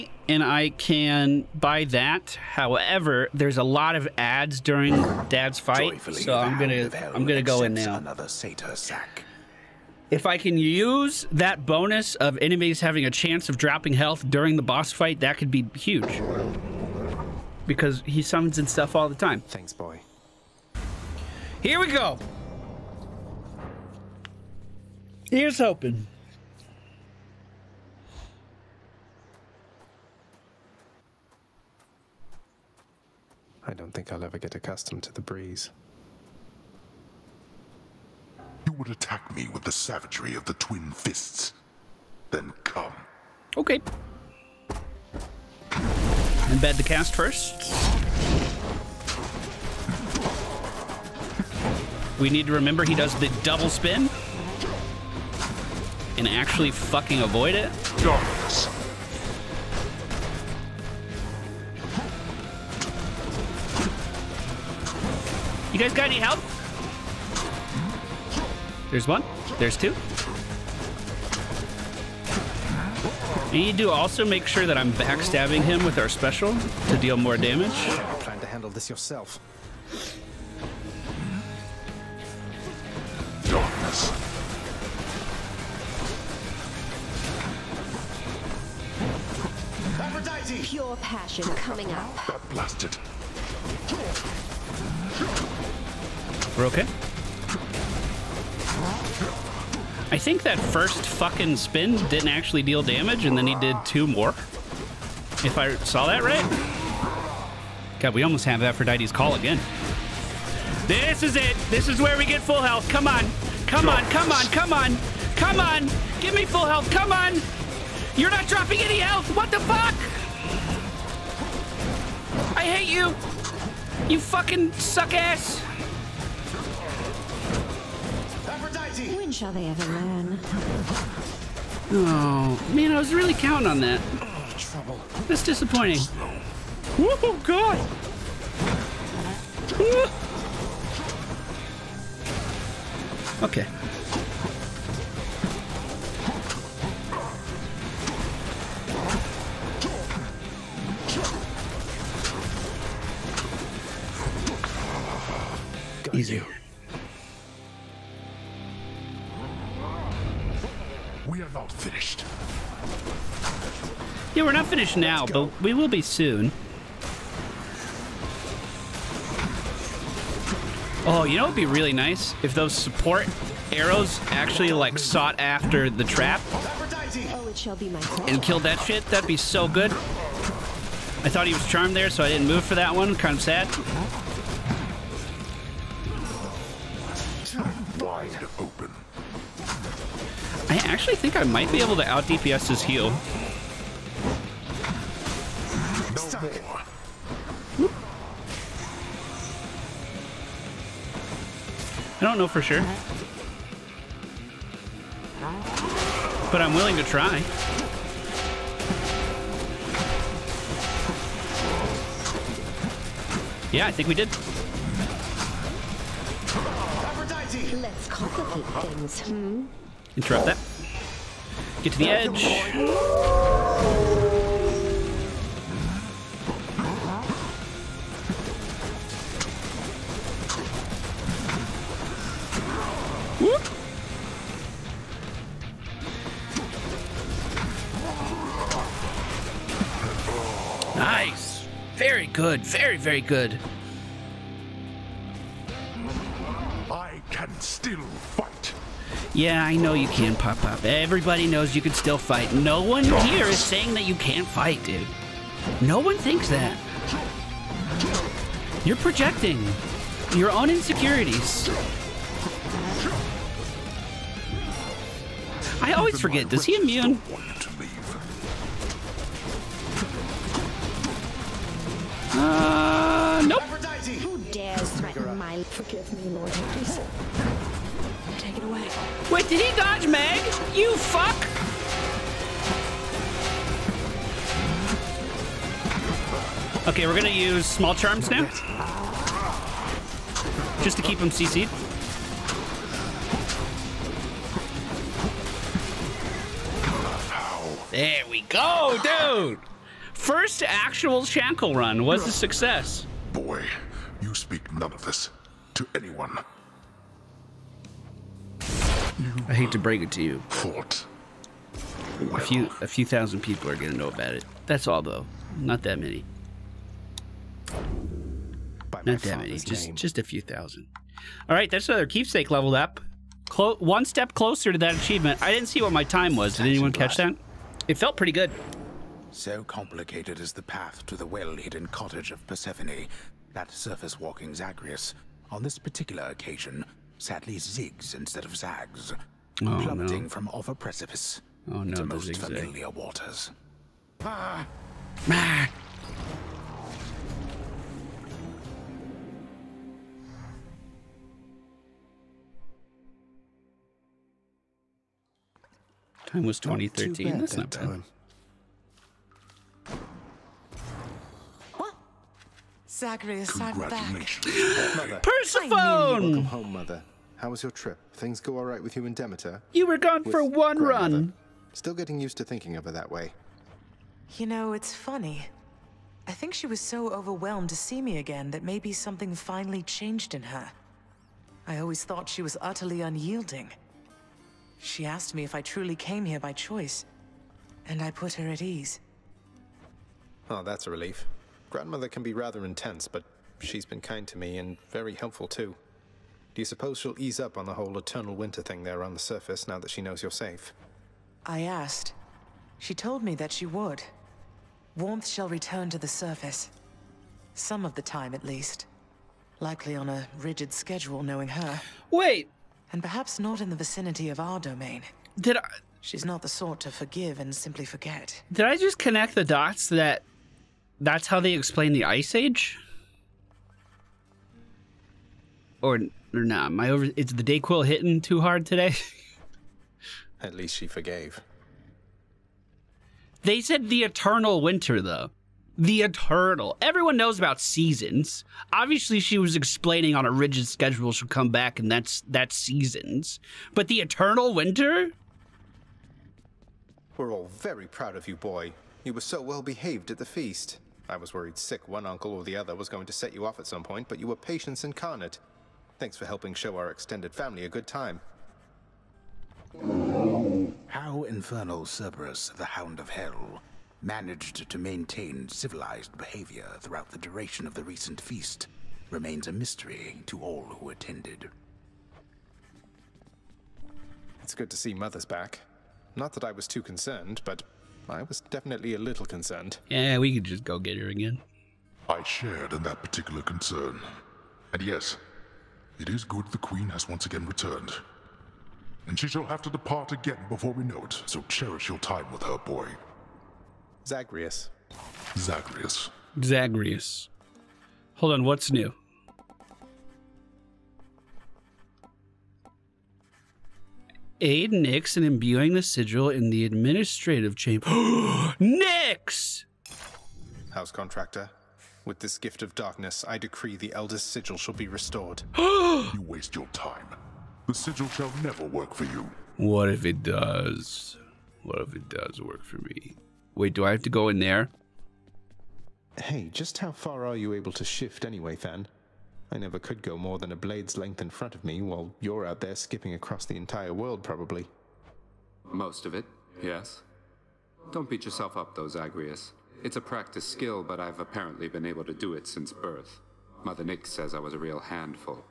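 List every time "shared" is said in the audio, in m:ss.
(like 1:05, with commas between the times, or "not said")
8:02.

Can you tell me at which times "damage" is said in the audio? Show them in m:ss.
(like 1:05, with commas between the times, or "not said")
1:17, 1:42.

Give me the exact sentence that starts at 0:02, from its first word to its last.
However, there's a lot of ads during Dad's fight, Joyfully so I'm gonna I'm gonna go in now.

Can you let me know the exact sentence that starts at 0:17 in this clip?
Because he summons and stuff all the time.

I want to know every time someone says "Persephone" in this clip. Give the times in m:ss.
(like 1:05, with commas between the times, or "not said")
5:32, 6:05.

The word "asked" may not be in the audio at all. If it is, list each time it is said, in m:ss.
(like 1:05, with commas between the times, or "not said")
6:25, 6:41.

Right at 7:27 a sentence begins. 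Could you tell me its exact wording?
We're all very proud of you, boy.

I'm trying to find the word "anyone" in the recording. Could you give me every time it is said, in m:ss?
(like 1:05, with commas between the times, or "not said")
5:05, 5:26.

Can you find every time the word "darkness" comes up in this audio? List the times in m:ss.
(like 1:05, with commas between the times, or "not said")
0:58, 8:32.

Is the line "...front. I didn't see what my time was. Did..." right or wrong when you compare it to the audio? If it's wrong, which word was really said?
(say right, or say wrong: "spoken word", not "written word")
wrong: "achievement", not "front".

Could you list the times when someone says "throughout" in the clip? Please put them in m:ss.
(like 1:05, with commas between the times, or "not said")
7:46.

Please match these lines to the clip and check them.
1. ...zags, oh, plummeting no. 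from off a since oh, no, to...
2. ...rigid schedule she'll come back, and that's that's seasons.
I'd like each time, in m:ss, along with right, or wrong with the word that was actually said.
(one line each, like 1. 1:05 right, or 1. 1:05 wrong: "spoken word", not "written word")
1. 5:38 wrong: "precipice", not "since"
2. 7:20 right.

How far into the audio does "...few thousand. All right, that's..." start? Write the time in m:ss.
5:20.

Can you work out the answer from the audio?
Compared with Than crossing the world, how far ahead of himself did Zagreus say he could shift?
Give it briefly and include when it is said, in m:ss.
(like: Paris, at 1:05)
a blade's length, at 8:50.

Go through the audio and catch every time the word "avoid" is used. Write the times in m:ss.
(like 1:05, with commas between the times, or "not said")
0:57.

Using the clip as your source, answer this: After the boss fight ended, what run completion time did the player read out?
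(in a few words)
2013.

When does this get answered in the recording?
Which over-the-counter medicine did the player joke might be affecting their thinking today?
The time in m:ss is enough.
7:07.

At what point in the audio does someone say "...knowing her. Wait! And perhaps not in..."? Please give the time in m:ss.
6:51.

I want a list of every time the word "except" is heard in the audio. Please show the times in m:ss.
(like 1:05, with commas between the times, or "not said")
not said.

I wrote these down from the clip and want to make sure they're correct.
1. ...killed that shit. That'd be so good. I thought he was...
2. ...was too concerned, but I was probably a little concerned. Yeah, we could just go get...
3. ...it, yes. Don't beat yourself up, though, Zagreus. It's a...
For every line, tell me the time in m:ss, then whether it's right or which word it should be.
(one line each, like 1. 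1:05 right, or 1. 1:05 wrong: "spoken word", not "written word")
1. 2:58 right
2. 7:56 wrong: "definitely", not "probably"
3. 8:56 right.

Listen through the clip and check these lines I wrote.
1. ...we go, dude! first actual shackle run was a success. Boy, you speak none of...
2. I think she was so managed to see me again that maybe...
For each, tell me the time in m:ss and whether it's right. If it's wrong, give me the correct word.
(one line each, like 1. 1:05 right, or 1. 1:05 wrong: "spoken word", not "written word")
1. 4:58 right
2. 6:16 wrong: "overwhelmed", not "managed".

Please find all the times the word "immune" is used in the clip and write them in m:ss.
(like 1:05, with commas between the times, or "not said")
4:26.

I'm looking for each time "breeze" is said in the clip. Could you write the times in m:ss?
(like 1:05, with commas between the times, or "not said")
0:35.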